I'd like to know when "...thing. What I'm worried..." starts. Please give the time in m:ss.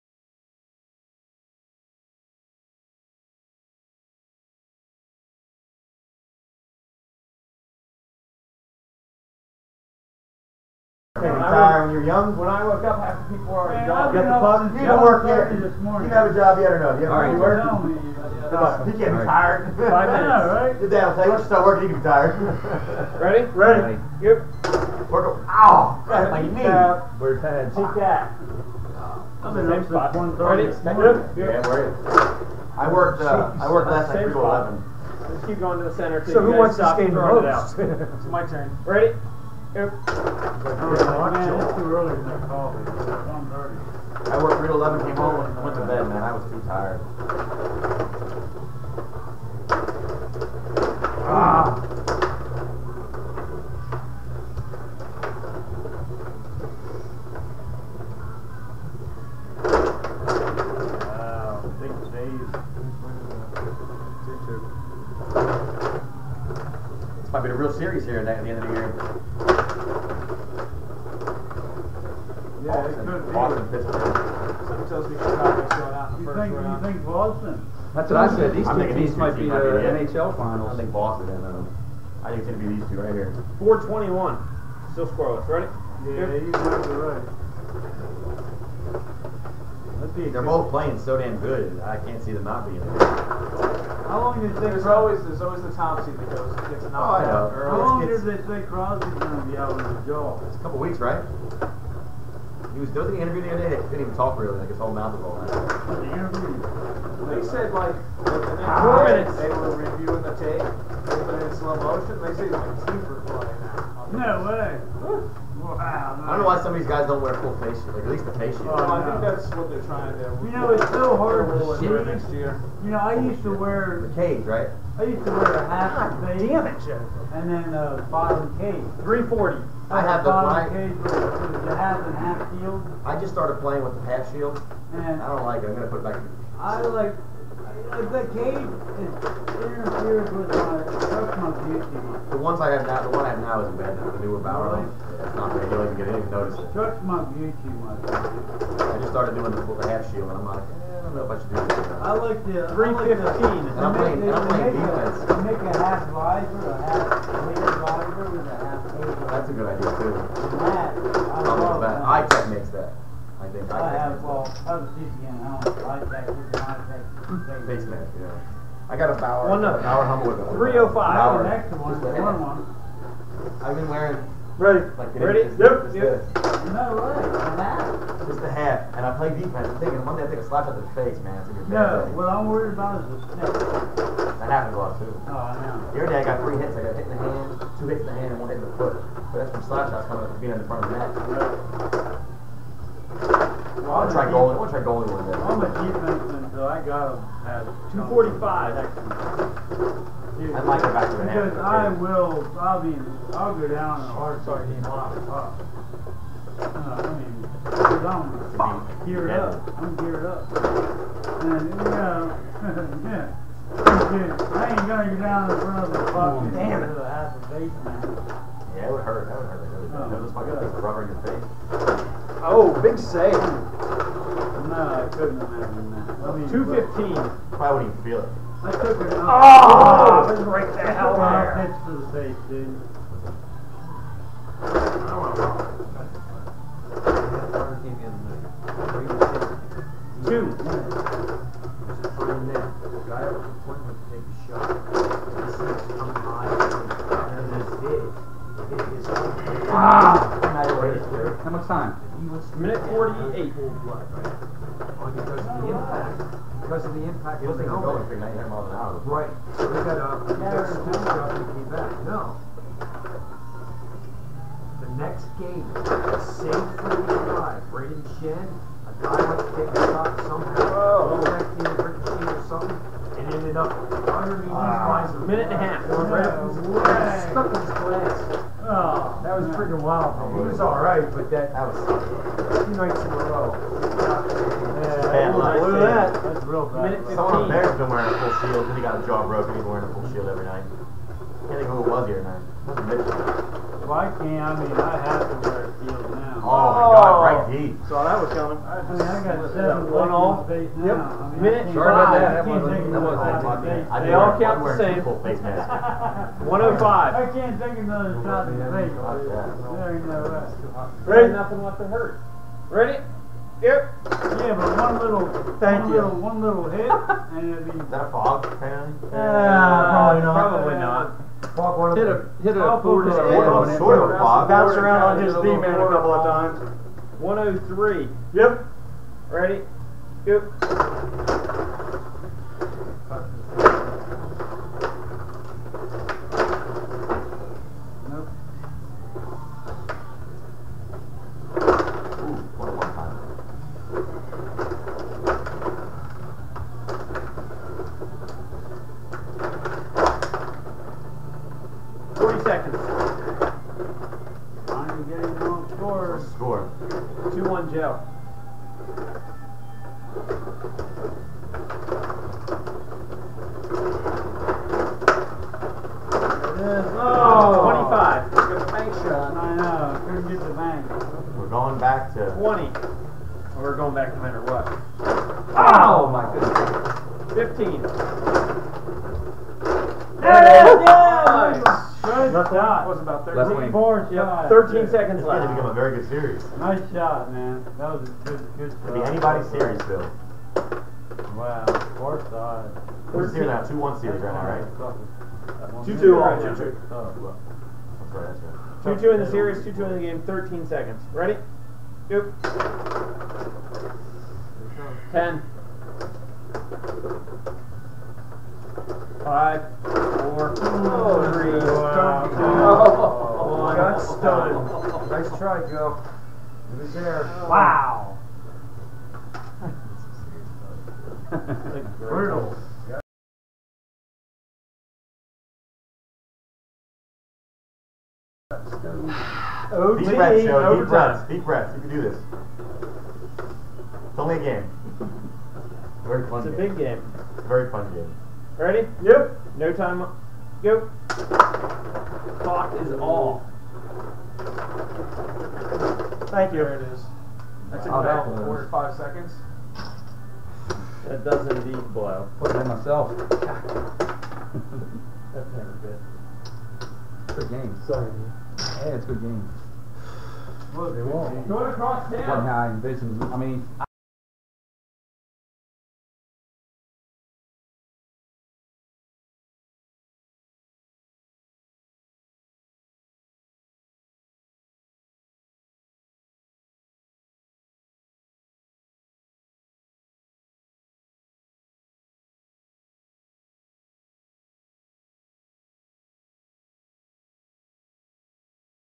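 3:02.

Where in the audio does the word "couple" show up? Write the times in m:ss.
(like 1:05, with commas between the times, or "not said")
1:40, 5:25.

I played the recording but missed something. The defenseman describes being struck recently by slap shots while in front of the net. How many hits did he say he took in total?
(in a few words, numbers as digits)
3.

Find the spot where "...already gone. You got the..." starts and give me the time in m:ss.
0:13.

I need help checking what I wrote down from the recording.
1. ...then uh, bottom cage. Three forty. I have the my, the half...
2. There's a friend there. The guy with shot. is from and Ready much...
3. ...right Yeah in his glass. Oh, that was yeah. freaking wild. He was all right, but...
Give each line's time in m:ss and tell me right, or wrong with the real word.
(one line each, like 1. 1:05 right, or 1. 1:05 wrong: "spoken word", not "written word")
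1. 2:07 right
2. 4:01 wrong: "How", not "Ready"
3. 4:36 wrong: "Stuck", not "Yeah".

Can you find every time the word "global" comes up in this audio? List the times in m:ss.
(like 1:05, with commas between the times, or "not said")
not said.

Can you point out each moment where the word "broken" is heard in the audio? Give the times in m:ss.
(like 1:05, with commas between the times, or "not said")
4:49.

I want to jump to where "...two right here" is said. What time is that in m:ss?
1:22.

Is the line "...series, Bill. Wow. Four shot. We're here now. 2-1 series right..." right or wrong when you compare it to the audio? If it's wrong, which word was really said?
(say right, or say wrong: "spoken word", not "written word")
right.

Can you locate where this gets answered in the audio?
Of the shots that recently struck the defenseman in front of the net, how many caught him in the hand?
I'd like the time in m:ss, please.
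3:07.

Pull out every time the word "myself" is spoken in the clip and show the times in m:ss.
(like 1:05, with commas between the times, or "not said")
7:32.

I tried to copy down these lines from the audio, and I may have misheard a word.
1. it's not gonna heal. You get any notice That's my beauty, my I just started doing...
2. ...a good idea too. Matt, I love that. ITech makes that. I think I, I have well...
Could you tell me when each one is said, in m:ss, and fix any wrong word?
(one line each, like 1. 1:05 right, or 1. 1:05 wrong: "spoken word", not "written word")
1. 2:25 right
2. 2:39 right.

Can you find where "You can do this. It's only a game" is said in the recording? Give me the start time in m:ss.
7:11.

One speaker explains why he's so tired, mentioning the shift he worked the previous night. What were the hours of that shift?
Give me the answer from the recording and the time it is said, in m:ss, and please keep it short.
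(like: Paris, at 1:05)
3 to 11, at 0:34.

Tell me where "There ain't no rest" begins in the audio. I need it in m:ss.
5:08.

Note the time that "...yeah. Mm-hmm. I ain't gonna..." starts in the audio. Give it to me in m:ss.
3:33.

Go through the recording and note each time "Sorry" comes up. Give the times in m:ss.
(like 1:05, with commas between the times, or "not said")
5:01, 7:37.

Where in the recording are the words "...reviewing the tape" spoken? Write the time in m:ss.
1:49.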